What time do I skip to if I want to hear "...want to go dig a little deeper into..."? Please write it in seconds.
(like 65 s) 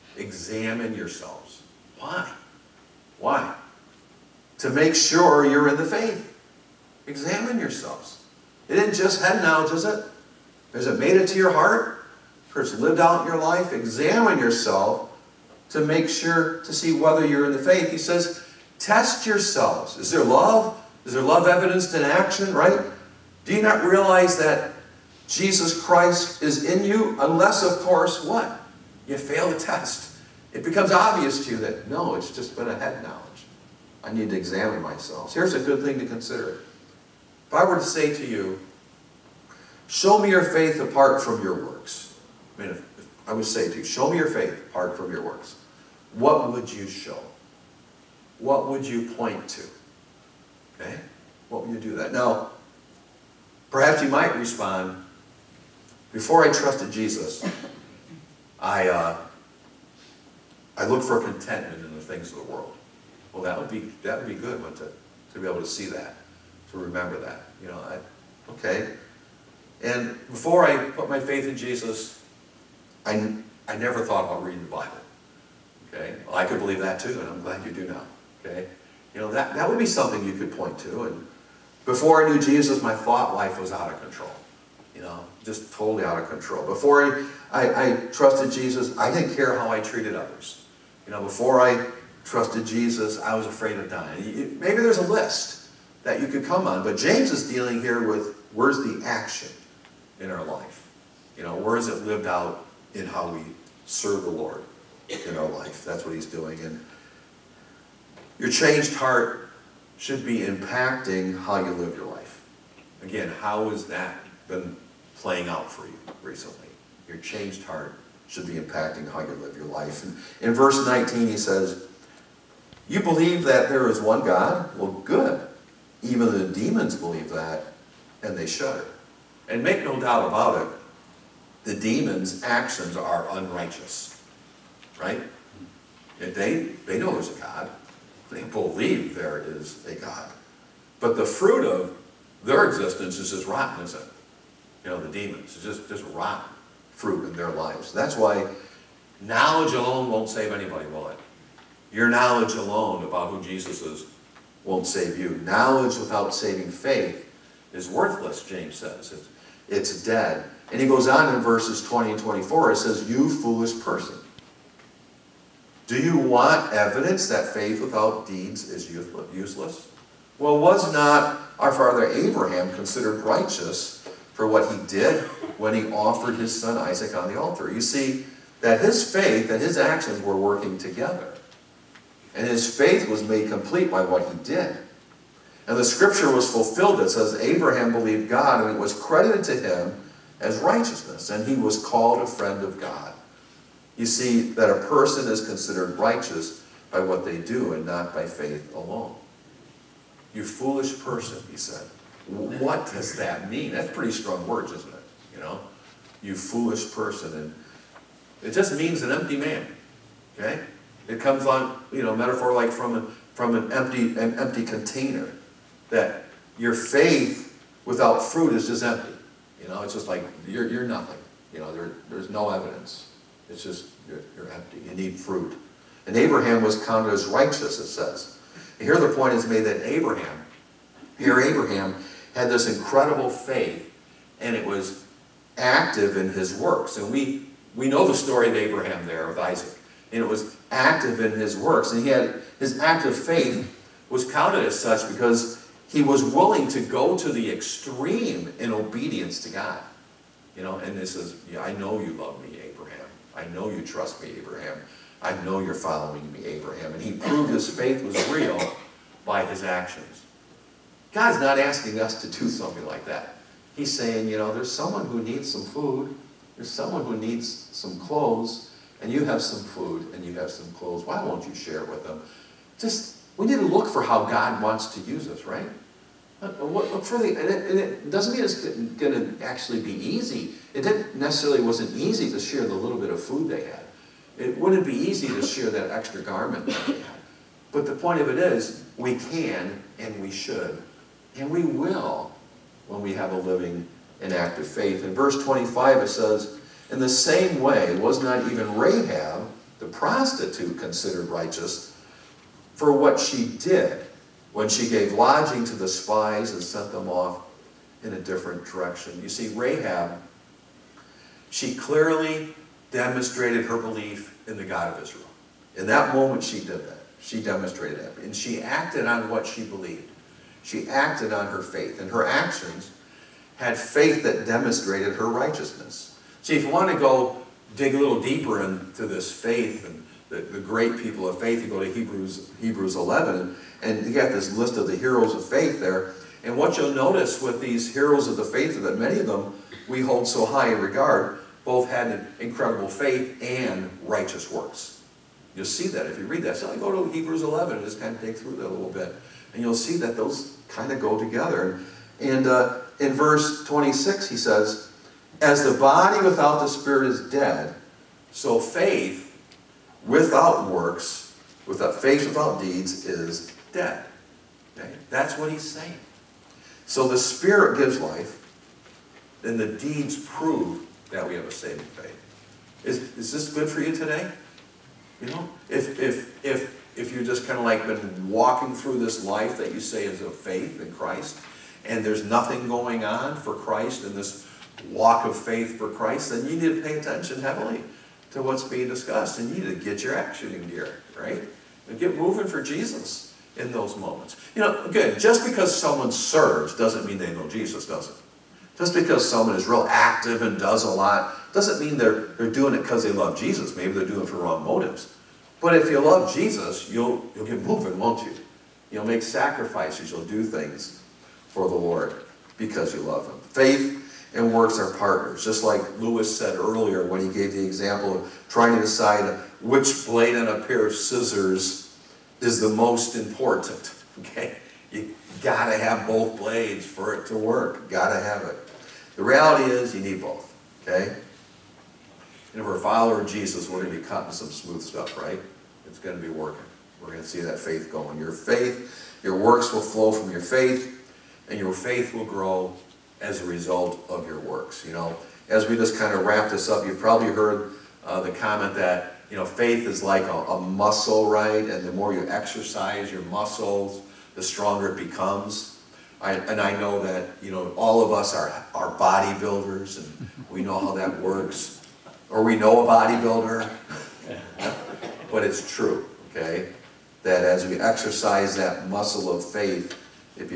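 326 s.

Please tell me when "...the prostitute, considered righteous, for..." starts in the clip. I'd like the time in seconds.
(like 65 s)
299 s.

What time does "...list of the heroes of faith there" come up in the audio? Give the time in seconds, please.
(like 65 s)
334 s.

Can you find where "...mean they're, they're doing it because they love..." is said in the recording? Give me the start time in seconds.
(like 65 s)
401 s.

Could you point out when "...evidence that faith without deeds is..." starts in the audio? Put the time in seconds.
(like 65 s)
166 s.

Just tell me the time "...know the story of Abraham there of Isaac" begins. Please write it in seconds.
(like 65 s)
237 s.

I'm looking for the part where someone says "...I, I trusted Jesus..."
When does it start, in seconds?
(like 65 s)
87 s.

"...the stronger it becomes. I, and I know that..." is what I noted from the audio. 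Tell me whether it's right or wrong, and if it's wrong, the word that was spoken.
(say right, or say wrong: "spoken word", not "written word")
right.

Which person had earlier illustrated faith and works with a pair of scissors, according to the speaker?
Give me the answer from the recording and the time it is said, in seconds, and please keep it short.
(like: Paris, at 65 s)
Lewis, at 415 s.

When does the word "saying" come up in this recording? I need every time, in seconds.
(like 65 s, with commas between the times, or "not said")
263 s, 365 s.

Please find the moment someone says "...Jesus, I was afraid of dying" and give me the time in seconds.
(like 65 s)
92 s.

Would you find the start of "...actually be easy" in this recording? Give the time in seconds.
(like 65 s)
279 s.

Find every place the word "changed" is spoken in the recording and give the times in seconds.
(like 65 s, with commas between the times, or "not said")
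108 s, 117 s.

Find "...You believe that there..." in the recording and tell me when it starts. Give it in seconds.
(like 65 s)
122 s.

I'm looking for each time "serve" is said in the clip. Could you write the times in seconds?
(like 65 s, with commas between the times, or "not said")
103 s, 396 s.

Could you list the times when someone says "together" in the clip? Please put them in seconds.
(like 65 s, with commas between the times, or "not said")
180 s, 351 s.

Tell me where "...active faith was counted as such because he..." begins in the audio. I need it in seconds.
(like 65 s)
242 s.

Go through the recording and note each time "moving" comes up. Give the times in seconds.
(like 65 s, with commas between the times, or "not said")
392 s, 407 s.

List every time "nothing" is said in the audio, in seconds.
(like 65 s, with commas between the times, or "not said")
220 s, 382 s.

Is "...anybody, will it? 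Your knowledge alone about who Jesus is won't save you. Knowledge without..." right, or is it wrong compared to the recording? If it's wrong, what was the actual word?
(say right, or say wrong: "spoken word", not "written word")
right.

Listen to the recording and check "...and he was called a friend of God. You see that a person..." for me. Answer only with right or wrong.
right.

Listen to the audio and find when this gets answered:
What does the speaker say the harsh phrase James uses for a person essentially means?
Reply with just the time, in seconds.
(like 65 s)
209 s.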